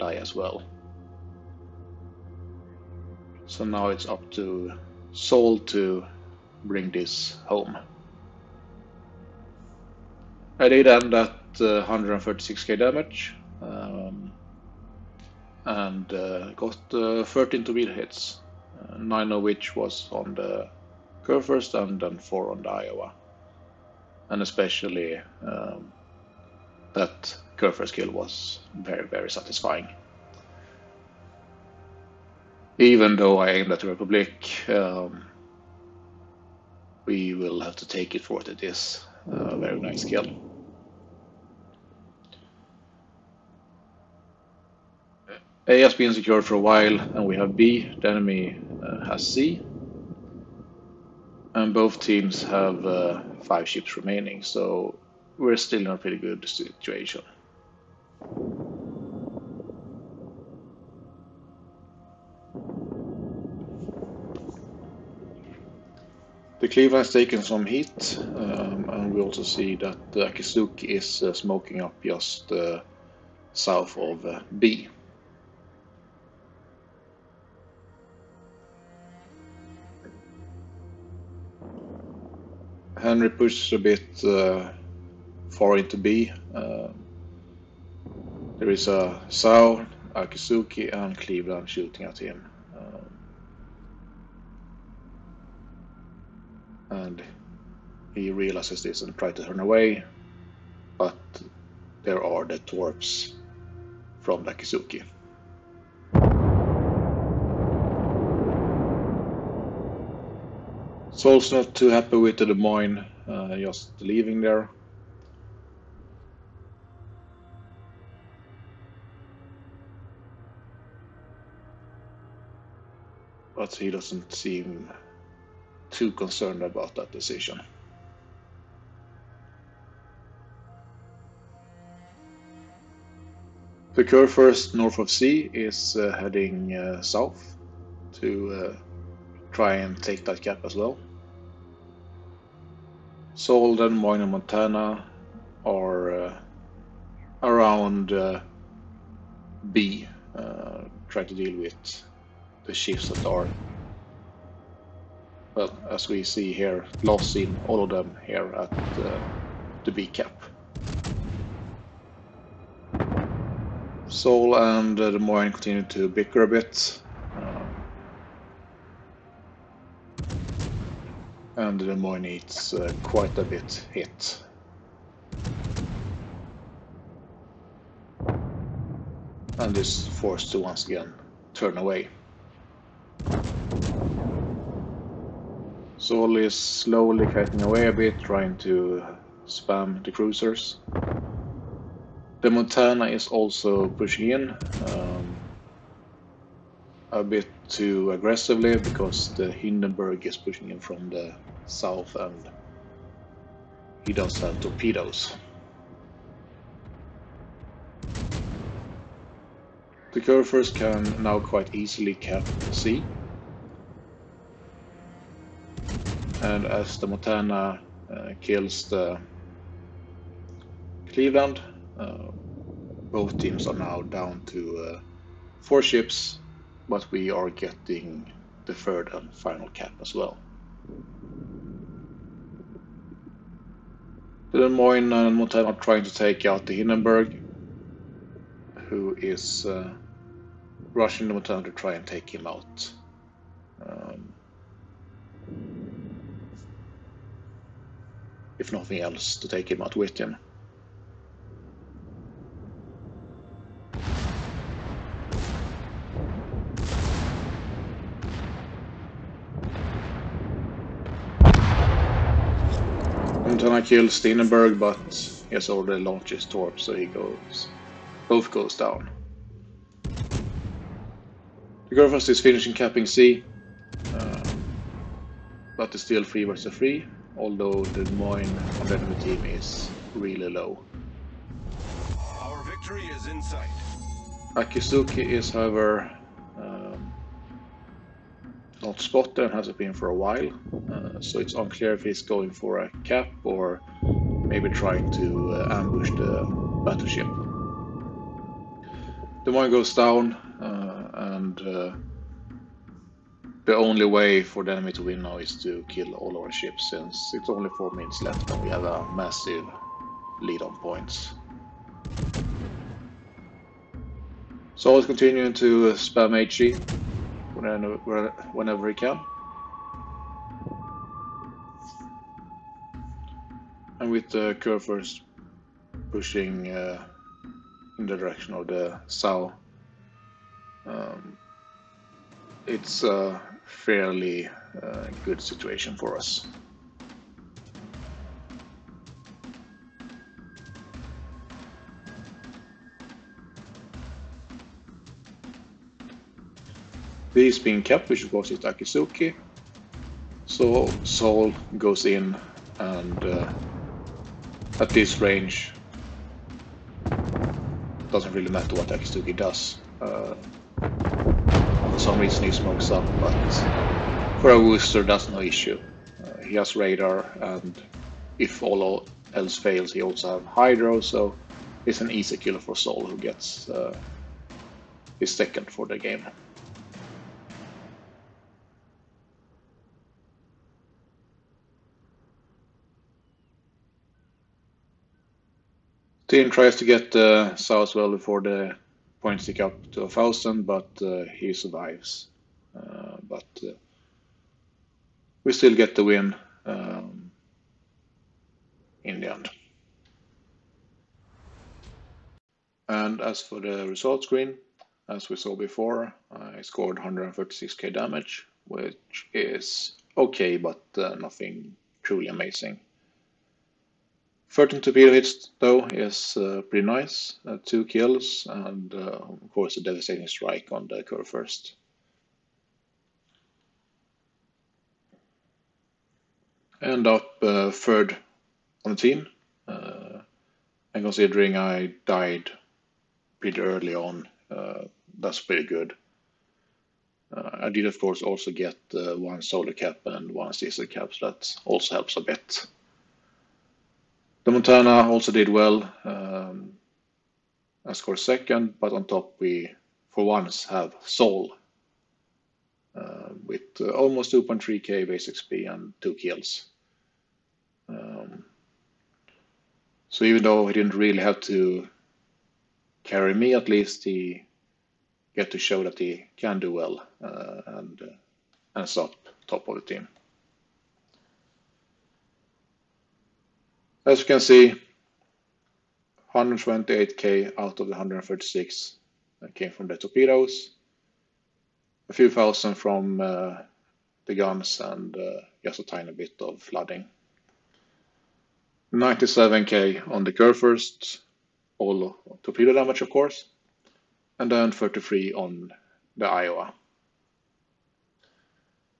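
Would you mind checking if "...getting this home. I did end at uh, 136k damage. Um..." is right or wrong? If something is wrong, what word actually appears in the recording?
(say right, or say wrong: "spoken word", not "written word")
wrong: "bring", not "getting".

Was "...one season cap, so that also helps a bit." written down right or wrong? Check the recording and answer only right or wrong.
right.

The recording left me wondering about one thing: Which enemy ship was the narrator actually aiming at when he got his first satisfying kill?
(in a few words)
Republic.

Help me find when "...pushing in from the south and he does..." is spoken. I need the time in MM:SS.
03:20.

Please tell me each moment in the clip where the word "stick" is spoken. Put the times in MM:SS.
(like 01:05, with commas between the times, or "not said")
06:29.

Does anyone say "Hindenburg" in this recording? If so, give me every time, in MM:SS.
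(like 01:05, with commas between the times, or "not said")
03:19, 03:56.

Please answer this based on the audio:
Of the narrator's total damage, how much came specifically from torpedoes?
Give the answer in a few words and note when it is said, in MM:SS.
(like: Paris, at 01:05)
128K, at 07:56.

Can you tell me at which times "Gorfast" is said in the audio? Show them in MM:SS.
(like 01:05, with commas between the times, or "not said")
04:31.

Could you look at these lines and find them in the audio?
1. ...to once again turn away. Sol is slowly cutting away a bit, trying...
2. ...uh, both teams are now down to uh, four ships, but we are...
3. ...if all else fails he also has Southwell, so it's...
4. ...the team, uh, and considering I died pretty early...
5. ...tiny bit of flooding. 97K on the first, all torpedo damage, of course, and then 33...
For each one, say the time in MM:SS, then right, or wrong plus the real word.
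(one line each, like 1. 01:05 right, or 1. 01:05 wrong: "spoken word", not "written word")
1. 03:00 right
2. 03:41 right
3. 06:08 wrong: "Hydro", not "Southwell"
4. 07:08 right
5. 08:05 right.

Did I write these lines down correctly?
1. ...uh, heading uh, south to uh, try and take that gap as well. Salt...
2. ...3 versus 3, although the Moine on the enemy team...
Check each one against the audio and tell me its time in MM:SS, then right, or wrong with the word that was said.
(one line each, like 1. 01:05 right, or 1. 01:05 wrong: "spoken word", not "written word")
1. 02:15 right
2. 04:36 right.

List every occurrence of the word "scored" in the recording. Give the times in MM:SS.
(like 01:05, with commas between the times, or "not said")
06:46, 07:27.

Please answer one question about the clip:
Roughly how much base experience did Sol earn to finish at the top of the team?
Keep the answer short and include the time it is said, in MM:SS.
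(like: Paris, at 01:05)
2.3k, at 07:34.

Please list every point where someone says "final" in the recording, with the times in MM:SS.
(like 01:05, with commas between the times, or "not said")
03:49.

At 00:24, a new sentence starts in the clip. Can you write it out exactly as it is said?
And especially um, that first kill was very, very satisfying.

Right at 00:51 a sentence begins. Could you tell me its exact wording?
And both teams have uh, five ships remaining, so we're still in a pretty good situation.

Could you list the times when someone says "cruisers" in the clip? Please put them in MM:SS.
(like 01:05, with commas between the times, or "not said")
03:10.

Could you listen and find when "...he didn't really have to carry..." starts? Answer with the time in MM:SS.
07:40.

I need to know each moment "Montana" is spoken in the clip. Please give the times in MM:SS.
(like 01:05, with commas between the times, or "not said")
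02:24, 03:12, 03:37, 03:55, 04:01, 07:24.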